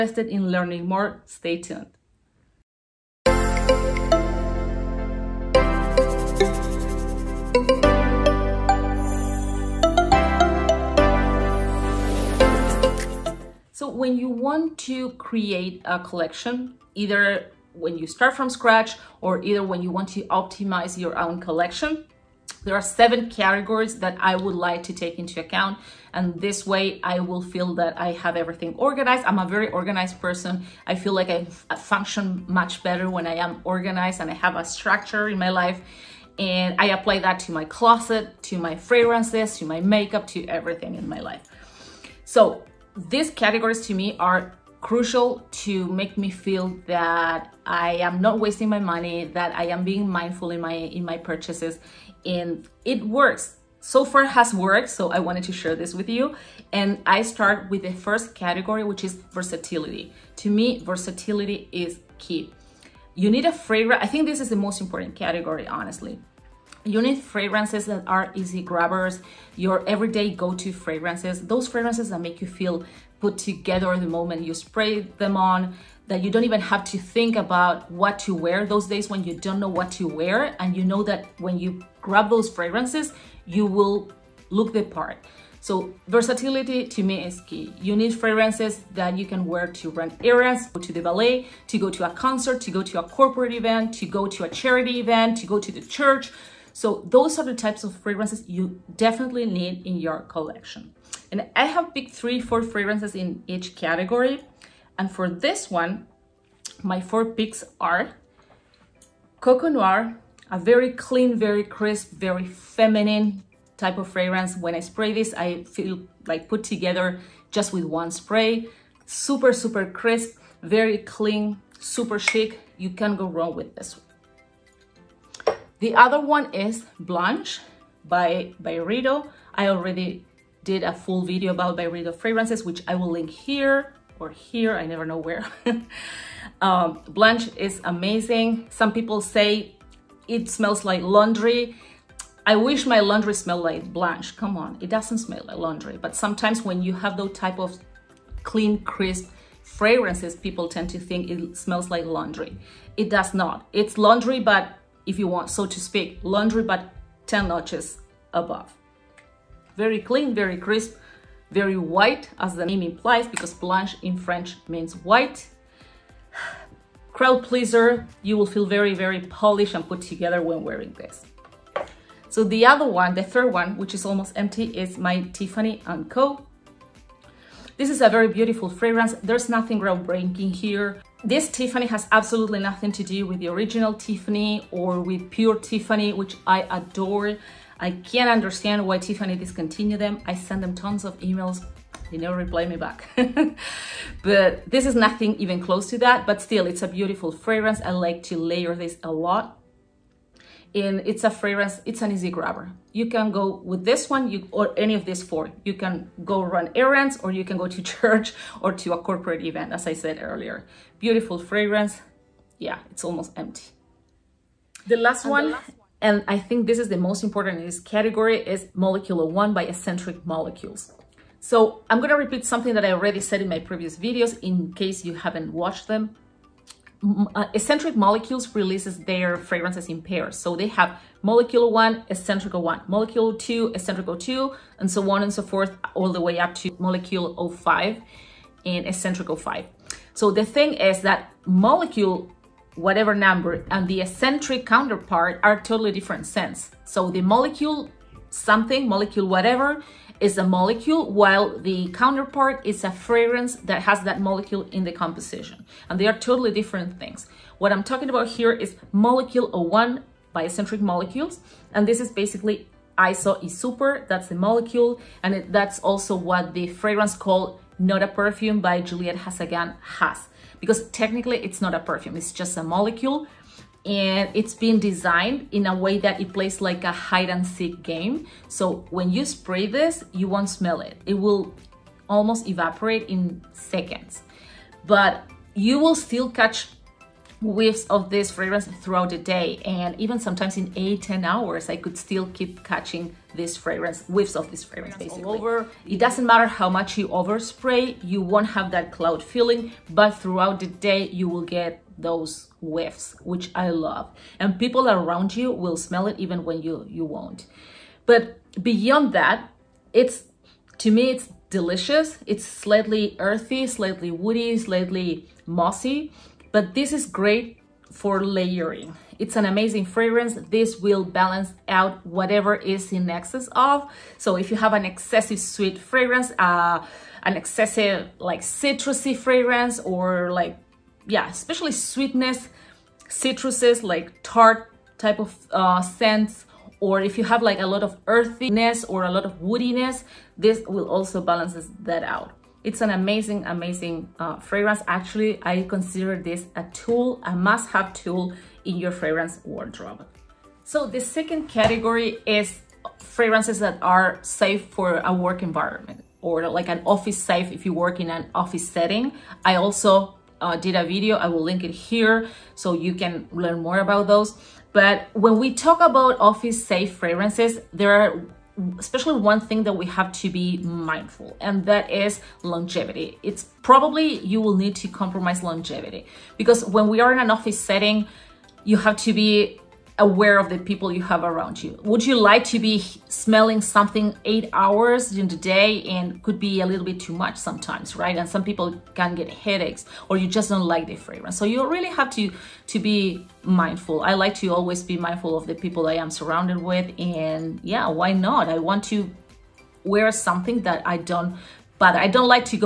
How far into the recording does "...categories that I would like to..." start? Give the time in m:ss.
0:23.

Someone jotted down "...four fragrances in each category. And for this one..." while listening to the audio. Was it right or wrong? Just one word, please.
right.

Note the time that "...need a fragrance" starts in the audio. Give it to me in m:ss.
1:03.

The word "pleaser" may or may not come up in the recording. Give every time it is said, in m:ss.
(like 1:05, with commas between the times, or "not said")
2:47.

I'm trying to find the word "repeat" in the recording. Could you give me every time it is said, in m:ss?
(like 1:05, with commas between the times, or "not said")
3:42.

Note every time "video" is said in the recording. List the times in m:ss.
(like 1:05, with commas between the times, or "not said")
2:11, 3:43, 6:00.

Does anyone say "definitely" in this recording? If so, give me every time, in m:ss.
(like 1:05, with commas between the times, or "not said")
1:38.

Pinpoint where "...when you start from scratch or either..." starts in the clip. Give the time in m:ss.
0:17.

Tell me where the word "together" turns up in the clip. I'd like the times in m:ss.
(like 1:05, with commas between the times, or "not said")
1:13, 1:56, 2:50.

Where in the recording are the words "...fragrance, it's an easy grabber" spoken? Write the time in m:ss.
3:21.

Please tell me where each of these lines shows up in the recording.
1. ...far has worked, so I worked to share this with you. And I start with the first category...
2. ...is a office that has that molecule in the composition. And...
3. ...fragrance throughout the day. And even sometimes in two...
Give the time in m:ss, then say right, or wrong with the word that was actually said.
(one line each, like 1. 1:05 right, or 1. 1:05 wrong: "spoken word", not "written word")
1. 0:54 wrong: "wanted", not "worked"
2. 4:12 wrong: "fragrance", not "office"
3. 4:48 wrong: "eight", not "two".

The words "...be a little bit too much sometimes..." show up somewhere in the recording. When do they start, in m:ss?
6:26.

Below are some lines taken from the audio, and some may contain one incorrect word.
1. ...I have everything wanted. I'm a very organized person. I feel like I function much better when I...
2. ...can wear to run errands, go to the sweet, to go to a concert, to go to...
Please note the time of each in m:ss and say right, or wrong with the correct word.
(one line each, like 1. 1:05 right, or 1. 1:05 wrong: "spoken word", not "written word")
1. 0:27 wrong: "organized", not "wanted"
2. 1:29 wrong: "ballet", not "sweet".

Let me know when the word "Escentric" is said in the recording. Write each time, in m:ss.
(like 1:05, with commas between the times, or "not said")
3:39, 3:47, 4:20.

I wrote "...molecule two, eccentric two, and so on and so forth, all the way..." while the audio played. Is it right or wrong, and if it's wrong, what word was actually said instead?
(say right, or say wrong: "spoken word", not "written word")
right.